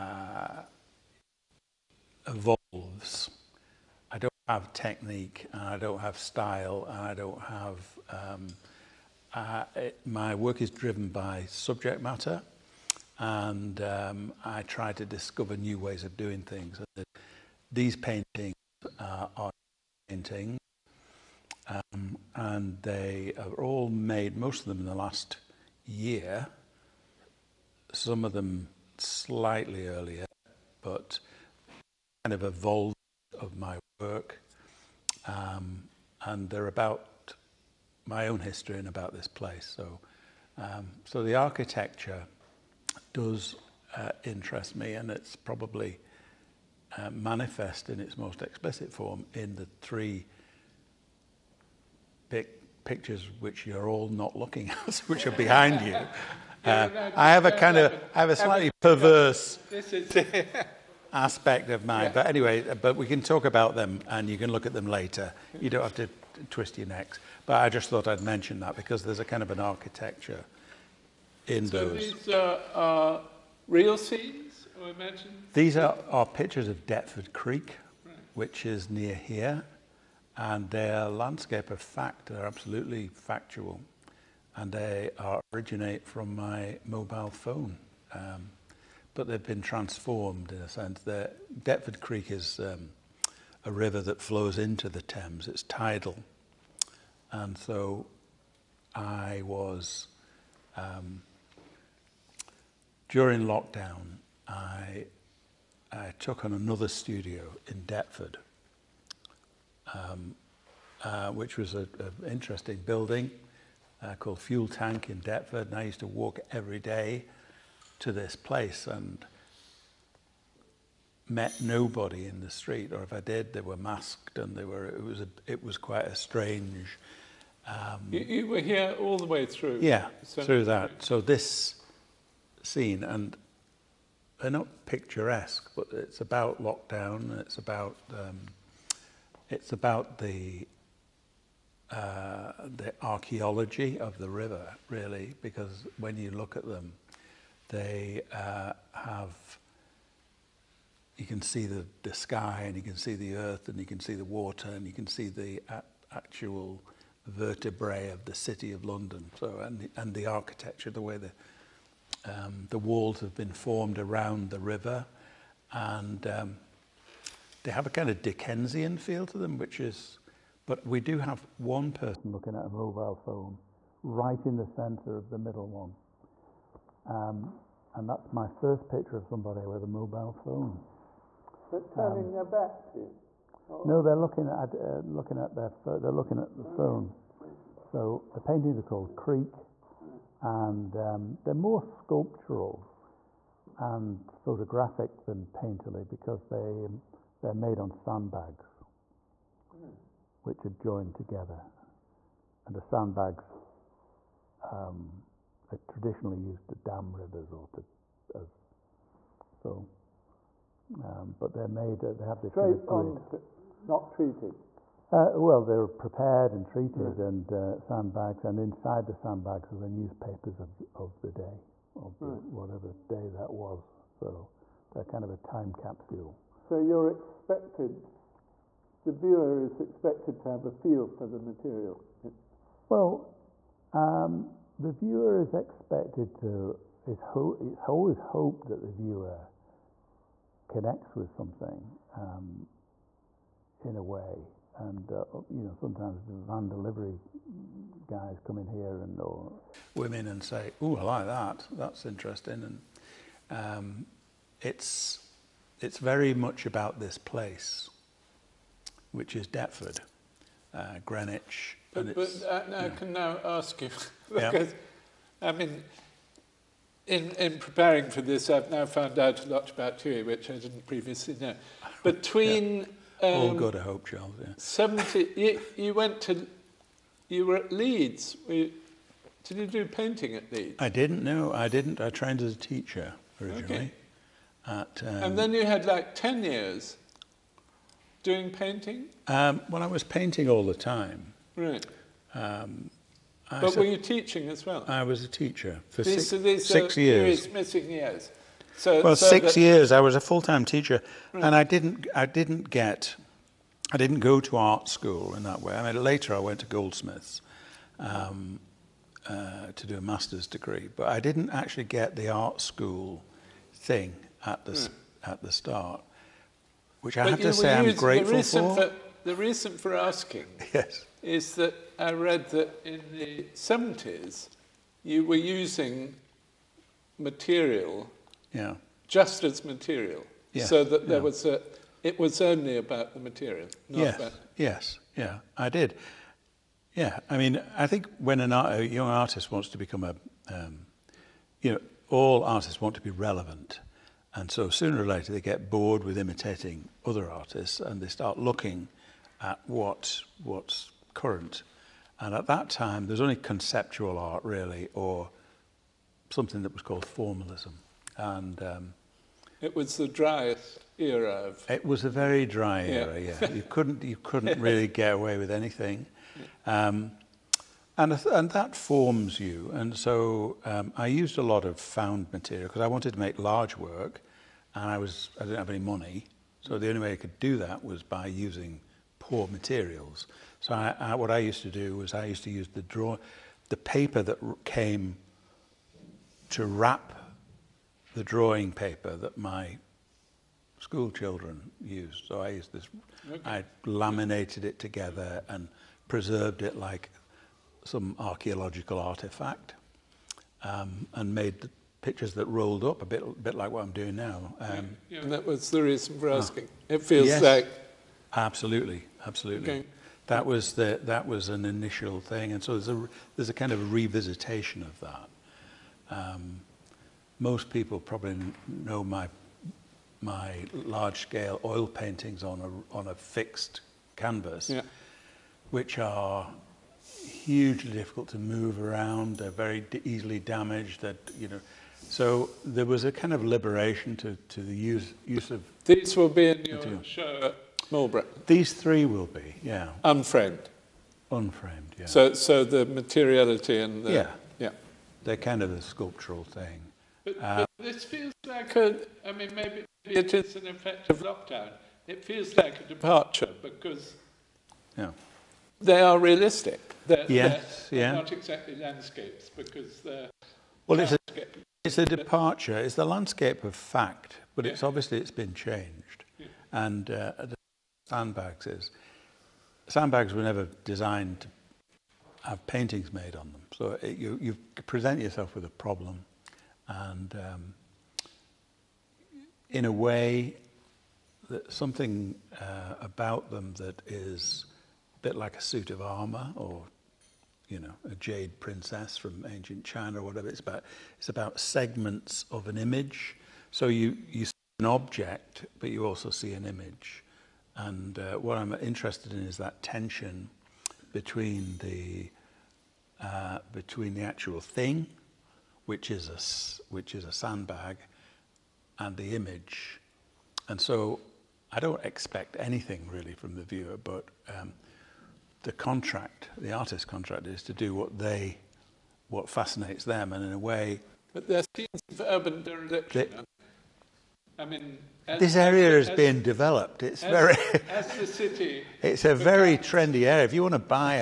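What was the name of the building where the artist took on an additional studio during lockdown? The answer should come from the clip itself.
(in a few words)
Fuel Tank.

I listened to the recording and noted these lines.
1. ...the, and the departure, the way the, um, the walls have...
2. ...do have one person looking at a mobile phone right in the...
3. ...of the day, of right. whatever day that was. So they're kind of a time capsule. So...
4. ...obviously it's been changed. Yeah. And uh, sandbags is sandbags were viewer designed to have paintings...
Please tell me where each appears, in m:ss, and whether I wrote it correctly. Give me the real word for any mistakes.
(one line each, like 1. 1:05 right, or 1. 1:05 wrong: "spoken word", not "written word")
1. 2:39 wrong: "architecture", not "departure"
2. 2:51 right
3. 3:40 right
4. 7:44 wrong: "never", not "viewer".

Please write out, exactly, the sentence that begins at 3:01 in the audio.
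But turning um, their back to you?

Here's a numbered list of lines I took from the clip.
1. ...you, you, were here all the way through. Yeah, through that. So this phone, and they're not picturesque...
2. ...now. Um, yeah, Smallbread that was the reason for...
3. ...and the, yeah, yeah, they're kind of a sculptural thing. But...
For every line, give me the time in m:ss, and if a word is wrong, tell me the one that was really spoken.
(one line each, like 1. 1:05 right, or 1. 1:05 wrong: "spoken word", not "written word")
1. 2:08 wrong: "scene", not "phone"
2. 6:44 wrong: "And", not "Smallbread"
3. 7:23 right.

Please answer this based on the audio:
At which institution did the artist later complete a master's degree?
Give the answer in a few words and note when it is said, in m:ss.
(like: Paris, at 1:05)
Goldsmiths, at 5:06.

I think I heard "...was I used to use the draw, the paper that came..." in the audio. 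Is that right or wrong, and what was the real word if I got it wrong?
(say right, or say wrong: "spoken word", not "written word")
right.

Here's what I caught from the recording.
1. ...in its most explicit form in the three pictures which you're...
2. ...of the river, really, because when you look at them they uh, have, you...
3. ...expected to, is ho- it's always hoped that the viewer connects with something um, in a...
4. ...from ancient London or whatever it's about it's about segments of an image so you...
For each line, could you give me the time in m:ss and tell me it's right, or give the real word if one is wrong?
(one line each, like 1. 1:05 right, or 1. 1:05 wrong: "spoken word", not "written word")
1. 0:47 right
2. 2:23 right
3. 3:55 right
4. 8:09 wrong: "China", not "London".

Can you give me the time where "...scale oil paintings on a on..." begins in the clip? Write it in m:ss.
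7:01.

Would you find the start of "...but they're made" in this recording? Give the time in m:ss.
3:31.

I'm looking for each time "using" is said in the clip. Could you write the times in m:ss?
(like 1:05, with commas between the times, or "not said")
5:25, 6:18.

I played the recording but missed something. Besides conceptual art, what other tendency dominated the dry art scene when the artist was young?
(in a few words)
formalism.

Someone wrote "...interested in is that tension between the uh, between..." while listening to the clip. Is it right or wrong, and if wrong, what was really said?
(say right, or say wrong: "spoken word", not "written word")
right.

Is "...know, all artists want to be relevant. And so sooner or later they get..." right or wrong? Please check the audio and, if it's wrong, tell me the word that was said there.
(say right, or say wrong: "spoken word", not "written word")
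right.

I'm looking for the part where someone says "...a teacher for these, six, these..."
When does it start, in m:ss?
4:55.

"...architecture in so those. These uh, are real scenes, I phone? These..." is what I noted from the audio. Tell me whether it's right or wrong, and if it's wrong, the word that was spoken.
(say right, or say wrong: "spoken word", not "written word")
wrong: "imagine", not "phone".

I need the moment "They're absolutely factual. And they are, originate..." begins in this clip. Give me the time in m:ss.
1:22.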